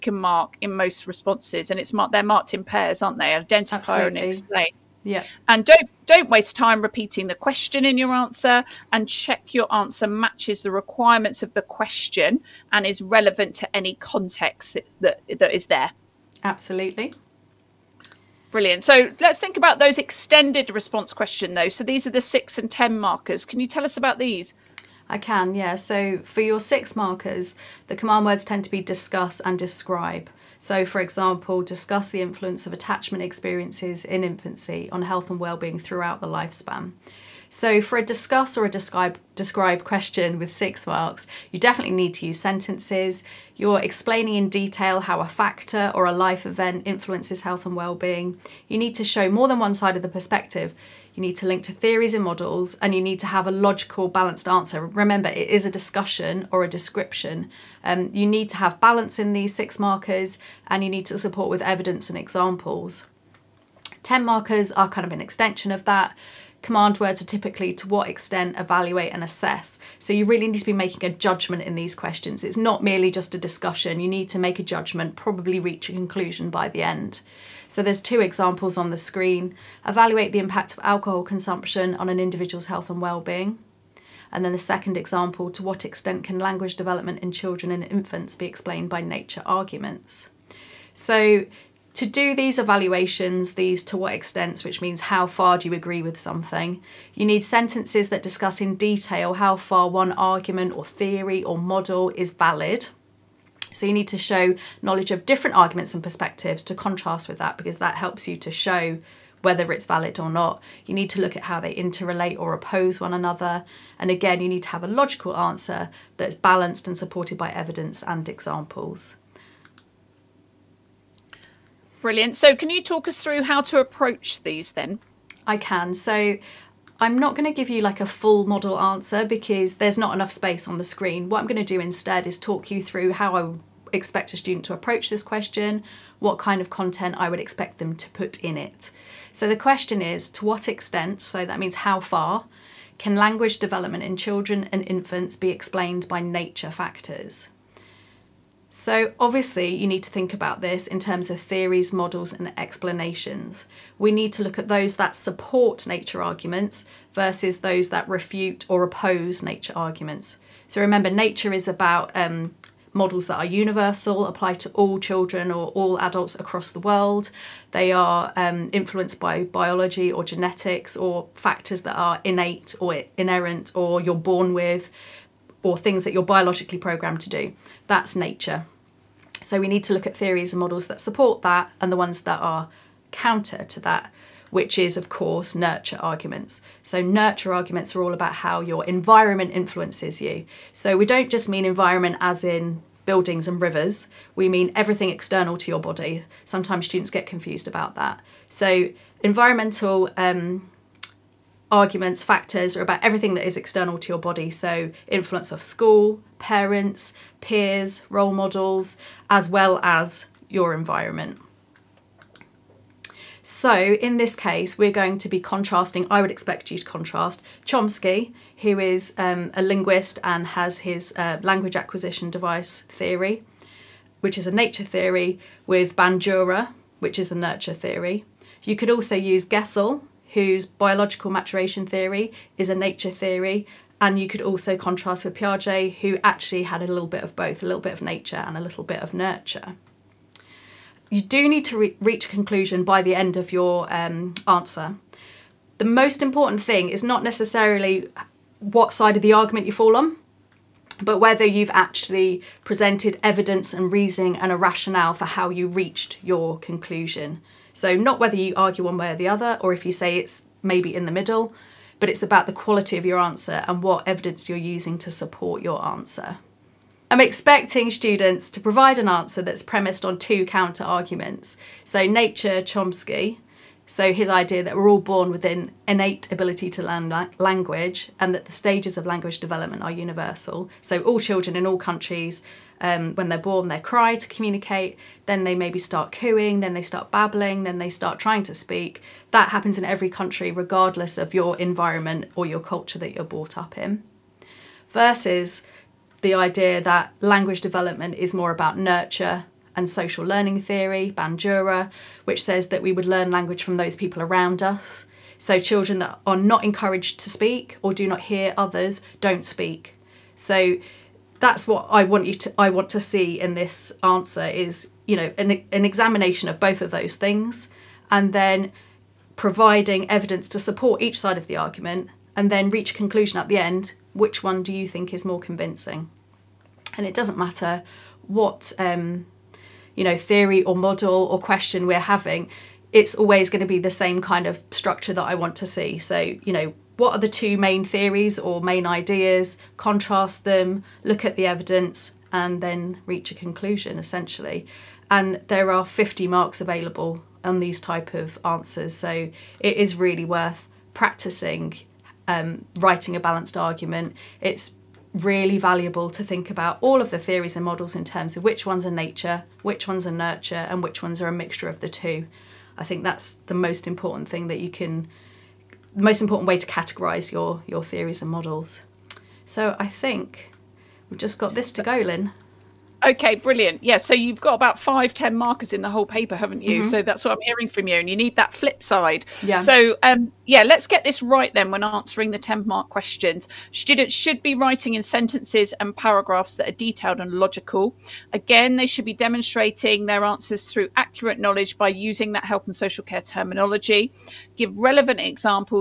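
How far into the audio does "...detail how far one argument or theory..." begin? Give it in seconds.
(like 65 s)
98 s.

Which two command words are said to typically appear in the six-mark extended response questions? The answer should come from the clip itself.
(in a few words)
discuss and describe.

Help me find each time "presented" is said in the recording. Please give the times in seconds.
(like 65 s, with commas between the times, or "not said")
252 s.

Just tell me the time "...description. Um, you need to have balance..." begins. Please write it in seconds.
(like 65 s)
56 s.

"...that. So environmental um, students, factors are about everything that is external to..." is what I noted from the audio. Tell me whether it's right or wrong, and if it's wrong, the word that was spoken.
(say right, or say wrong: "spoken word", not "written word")
wrong: "arguments", not "students".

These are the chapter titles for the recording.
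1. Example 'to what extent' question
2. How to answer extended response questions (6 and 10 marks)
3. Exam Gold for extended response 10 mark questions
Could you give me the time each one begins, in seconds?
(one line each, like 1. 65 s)
1. 119 s
2. 19 s
3. 369 s.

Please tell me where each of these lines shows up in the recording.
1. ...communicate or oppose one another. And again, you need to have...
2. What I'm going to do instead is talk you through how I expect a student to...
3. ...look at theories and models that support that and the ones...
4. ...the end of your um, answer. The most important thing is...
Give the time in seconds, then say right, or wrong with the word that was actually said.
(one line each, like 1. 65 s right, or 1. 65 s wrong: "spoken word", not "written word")
1. 111 s wrong: "interrelate", not "communicate"
2. 131 s right
3. 179 s right
4. 243 s right.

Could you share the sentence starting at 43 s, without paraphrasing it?
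You're explaining in detail how a factor or a life event influences health and well-being.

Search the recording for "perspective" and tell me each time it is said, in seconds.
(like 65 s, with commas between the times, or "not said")
50 s, 106 s.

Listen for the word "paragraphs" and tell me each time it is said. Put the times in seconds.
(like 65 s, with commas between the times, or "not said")
385 s.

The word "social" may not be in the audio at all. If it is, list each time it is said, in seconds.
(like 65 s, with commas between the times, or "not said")
299 s, 392 s.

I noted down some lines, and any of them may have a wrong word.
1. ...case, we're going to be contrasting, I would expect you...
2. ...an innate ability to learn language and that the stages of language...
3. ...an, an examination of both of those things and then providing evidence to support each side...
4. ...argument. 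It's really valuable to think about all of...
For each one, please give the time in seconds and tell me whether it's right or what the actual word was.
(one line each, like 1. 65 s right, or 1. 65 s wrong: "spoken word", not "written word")
1. 214 s right
2. 275 s right
3. 315 s right
4. 353 s right.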